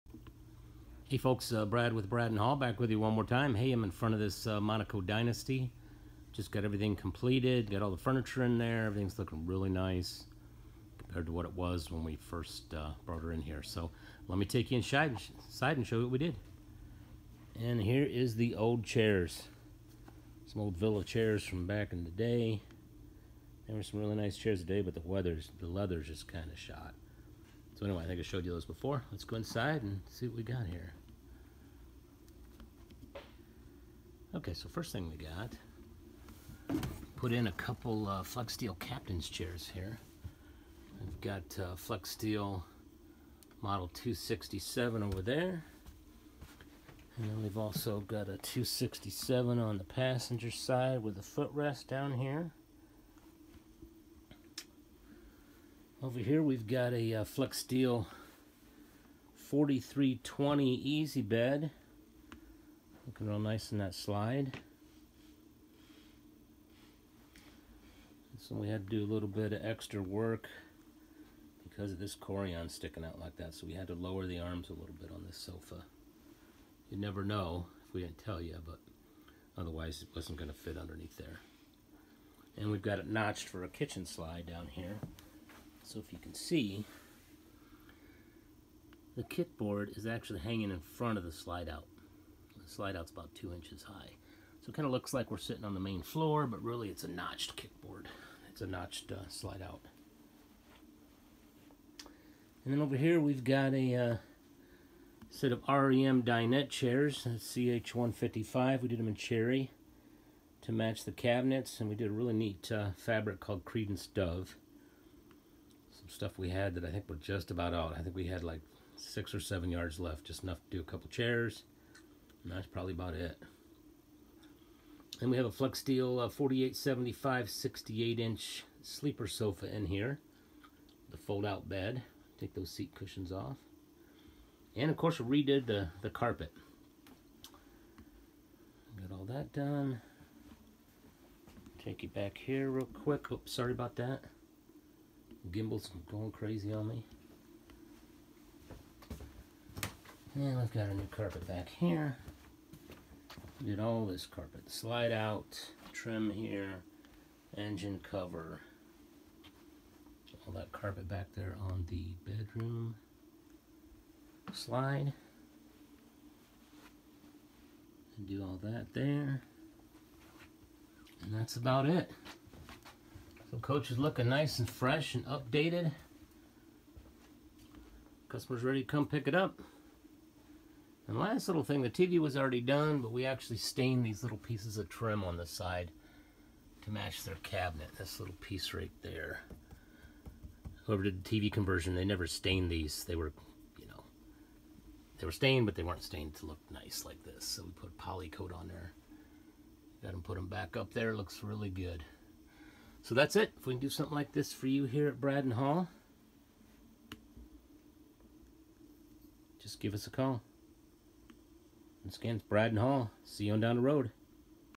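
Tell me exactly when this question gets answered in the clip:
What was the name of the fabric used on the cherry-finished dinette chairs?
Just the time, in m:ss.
1:53.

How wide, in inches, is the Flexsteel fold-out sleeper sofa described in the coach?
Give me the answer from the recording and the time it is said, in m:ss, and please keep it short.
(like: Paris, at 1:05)
68 inches, at 2:07.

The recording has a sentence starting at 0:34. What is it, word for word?
Okay, so first thing we got, put in a couple uh, Flexsteel captain's chairs here.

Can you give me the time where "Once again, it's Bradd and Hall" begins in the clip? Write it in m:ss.
3:32.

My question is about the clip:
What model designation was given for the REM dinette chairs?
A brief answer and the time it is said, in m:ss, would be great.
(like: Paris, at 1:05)
CH155, at 1:47.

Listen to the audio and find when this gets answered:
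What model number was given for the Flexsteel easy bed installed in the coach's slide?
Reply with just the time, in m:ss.
0:59.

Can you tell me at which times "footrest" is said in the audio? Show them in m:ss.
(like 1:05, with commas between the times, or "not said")
0:51.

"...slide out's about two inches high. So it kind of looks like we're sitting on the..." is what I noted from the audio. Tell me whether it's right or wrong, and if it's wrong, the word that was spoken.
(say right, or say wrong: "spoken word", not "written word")
right.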